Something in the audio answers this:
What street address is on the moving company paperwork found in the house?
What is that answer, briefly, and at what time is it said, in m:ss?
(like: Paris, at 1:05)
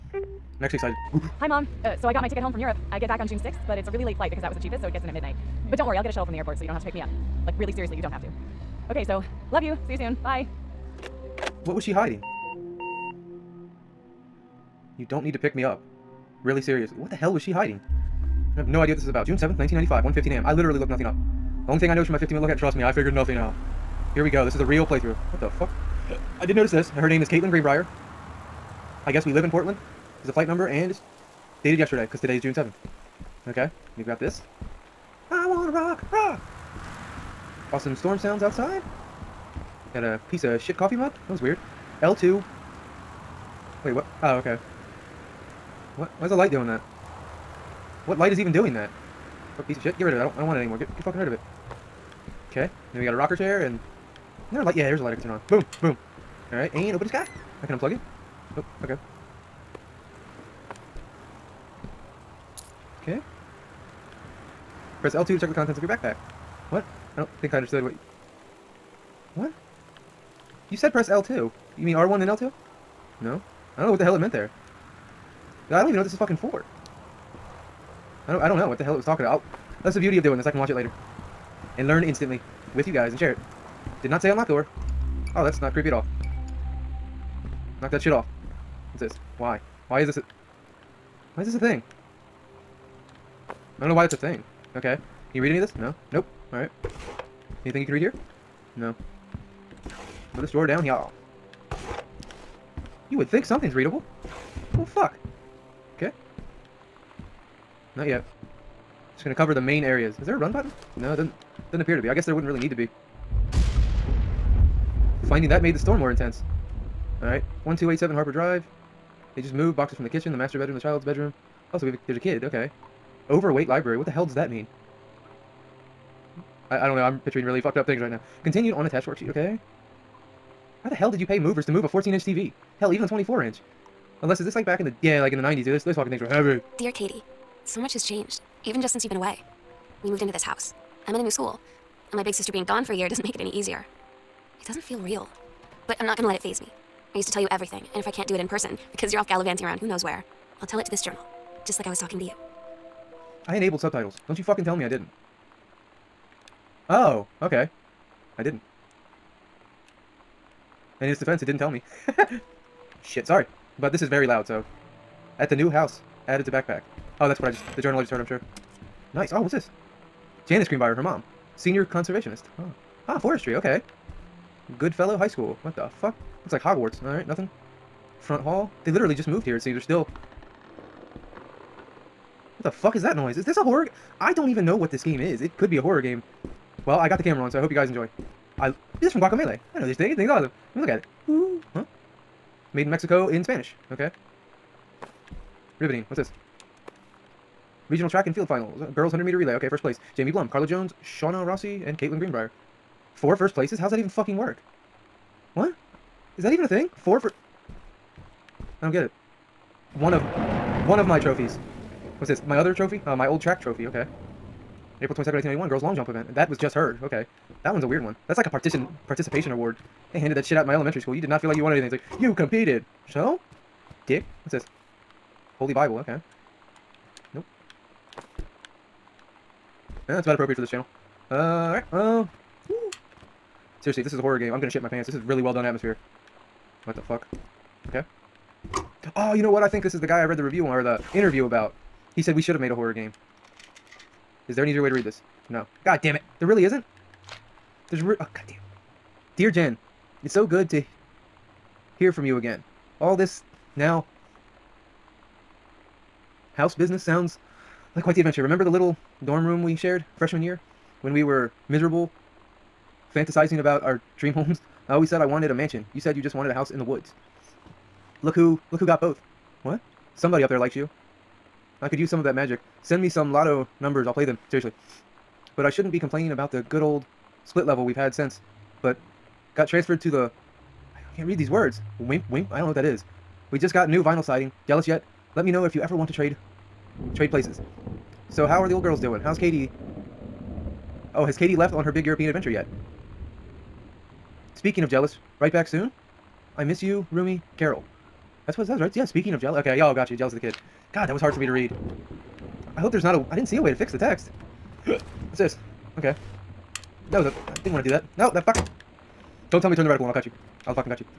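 1287 Harper Drive, at 1:57.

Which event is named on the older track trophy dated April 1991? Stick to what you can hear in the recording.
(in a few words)
Girls long jump.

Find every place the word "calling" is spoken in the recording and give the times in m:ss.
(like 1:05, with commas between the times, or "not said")
not said.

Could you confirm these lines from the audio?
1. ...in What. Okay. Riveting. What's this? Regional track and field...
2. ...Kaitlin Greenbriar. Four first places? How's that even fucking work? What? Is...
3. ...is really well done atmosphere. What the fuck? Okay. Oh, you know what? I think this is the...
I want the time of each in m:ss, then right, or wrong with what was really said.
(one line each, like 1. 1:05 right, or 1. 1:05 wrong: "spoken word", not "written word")
1. 3:13 wrong: "Spanish", not "What"
2. 3:21 right
3. 3:55 right.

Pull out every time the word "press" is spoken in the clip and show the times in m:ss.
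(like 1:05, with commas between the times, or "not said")
1:05, 1:10.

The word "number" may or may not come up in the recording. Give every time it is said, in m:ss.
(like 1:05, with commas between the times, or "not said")
0:30, 4:33.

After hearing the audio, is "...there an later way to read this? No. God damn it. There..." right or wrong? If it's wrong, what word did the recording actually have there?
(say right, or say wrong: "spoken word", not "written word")
wrong: "easier", not "later".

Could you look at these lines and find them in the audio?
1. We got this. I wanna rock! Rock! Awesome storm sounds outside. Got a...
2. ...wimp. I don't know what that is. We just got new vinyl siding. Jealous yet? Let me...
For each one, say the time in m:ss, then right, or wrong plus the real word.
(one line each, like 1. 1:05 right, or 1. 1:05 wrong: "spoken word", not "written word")
1. 0:33 right
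2. 4:42 right.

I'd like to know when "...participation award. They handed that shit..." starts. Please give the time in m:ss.
3:39.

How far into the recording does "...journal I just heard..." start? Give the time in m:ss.
2:47.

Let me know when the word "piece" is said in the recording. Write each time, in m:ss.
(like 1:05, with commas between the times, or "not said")
0:40, 0:49.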